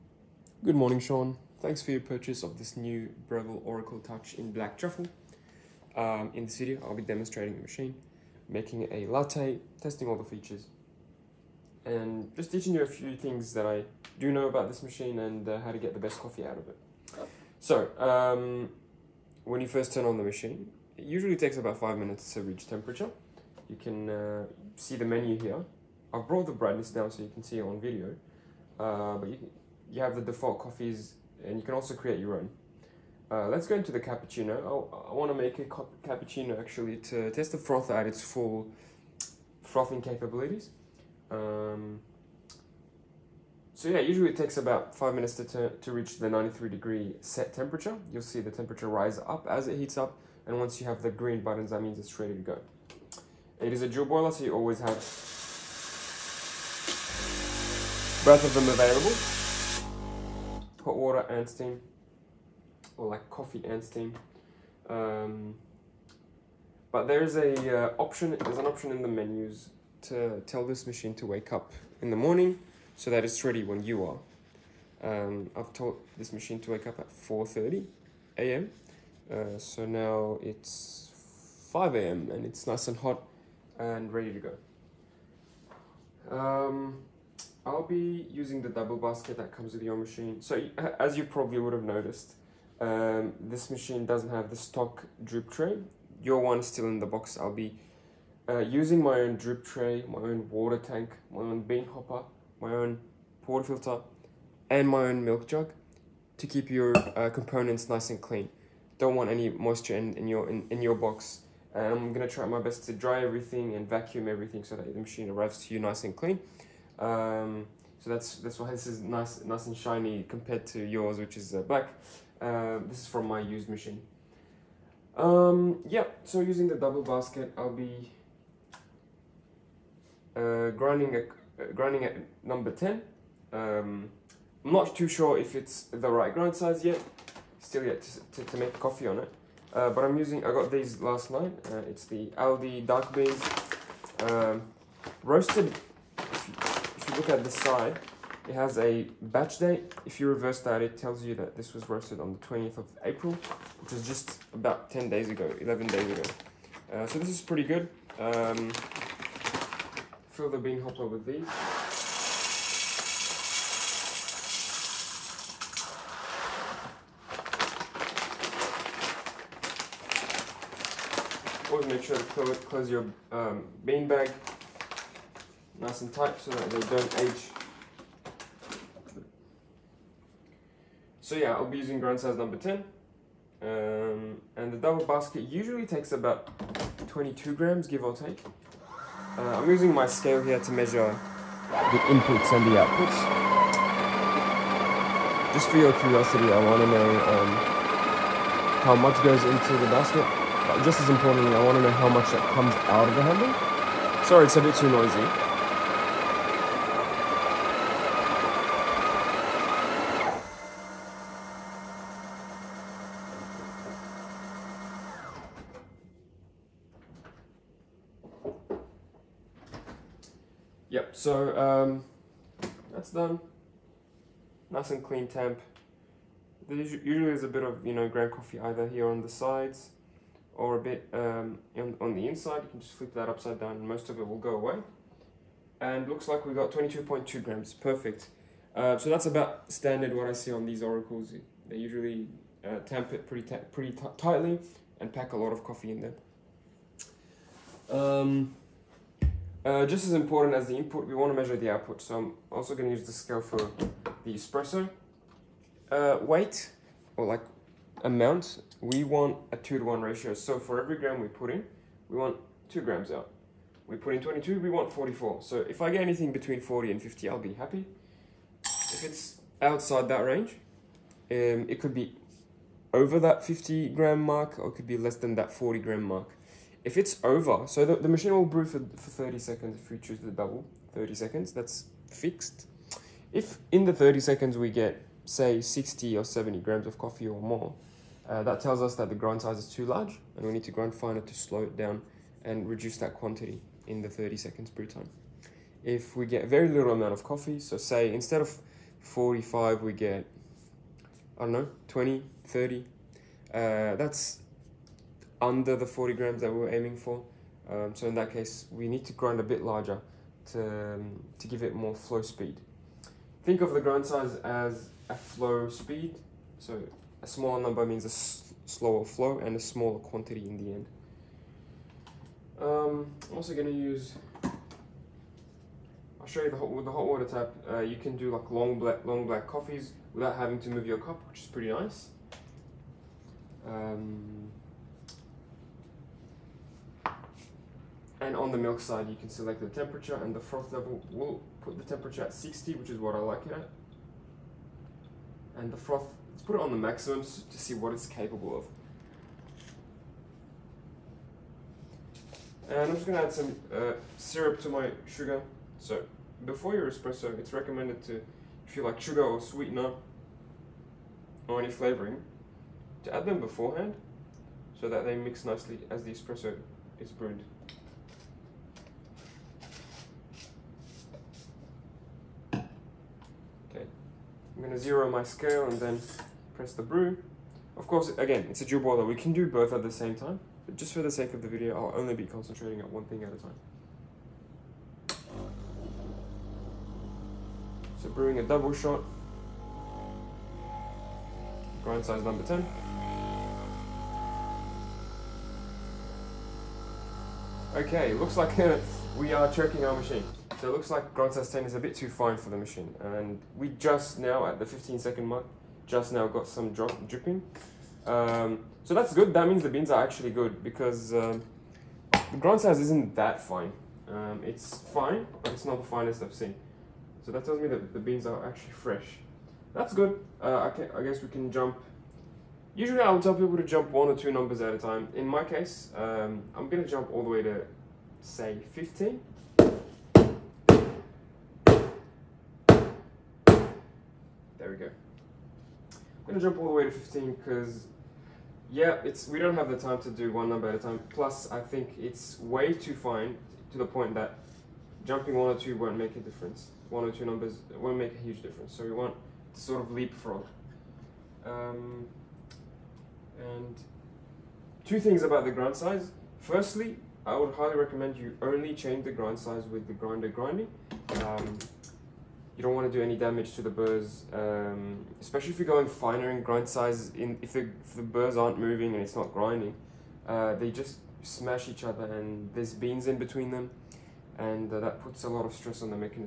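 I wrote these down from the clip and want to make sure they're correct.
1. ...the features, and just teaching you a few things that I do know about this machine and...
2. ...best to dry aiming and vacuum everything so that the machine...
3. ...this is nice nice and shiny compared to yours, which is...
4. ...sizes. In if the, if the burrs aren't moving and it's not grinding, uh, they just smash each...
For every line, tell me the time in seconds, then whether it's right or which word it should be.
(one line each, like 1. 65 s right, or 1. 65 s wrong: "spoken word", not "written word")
1. 10 s right
2. 112 s wrong: "everything", not "aiming"
3. 118 s right
4. 466 s right.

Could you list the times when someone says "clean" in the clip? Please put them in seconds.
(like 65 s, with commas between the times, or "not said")
108 s, 116 s, 225 s.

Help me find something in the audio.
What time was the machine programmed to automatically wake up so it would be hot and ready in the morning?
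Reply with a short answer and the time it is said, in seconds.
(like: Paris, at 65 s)
4:30 a.m., at 77 s.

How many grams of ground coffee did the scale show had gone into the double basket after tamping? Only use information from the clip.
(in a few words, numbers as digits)
22.2 grams.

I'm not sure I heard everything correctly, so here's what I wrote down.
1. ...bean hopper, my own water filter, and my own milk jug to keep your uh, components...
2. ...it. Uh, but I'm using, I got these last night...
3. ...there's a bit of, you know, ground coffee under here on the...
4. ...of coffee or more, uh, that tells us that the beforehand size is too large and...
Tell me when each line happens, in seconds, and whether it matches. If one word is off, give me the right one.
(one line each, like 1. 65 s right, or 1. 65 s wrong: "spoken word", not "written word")
1. 101 s right
2. 139 s right
3. 227 s wrong: "either", not "under"
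4. 286 s wrong: "grind", not "beforehand".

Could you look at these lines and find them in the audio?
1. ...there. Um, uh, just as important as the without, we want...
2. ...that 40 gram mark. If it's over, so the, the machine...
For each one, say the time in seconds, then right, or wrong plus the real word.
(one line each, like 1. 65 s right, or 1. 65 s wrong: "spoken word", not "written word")
1. 246 s wrong: "input", not "without"
2. 275 s right.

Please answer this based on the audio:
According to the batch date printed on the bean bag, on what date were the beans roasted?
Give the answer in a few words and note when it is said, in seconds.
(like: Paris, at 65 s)
20th of April, at 152 s.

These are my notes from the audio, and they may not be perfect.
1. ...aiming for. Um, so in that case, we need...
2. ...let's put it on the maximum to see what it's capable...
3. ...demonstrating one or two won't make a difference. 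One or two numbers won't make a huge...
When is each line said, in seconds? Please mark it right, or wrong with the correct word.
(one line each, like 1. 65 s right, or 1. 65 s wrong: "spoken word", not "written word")
1. 306 s right
2. 346 s right
3. 445 s wrong: "jumping", not "demonstrating".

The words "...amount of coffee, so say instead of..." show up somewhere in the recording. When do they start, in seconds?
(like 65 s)
296 s.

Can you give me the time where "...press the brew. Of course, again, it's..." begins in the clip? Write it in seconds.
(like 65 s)
376 s.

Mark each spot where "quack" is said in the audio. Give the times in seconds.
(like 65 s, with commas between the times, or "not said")
not said.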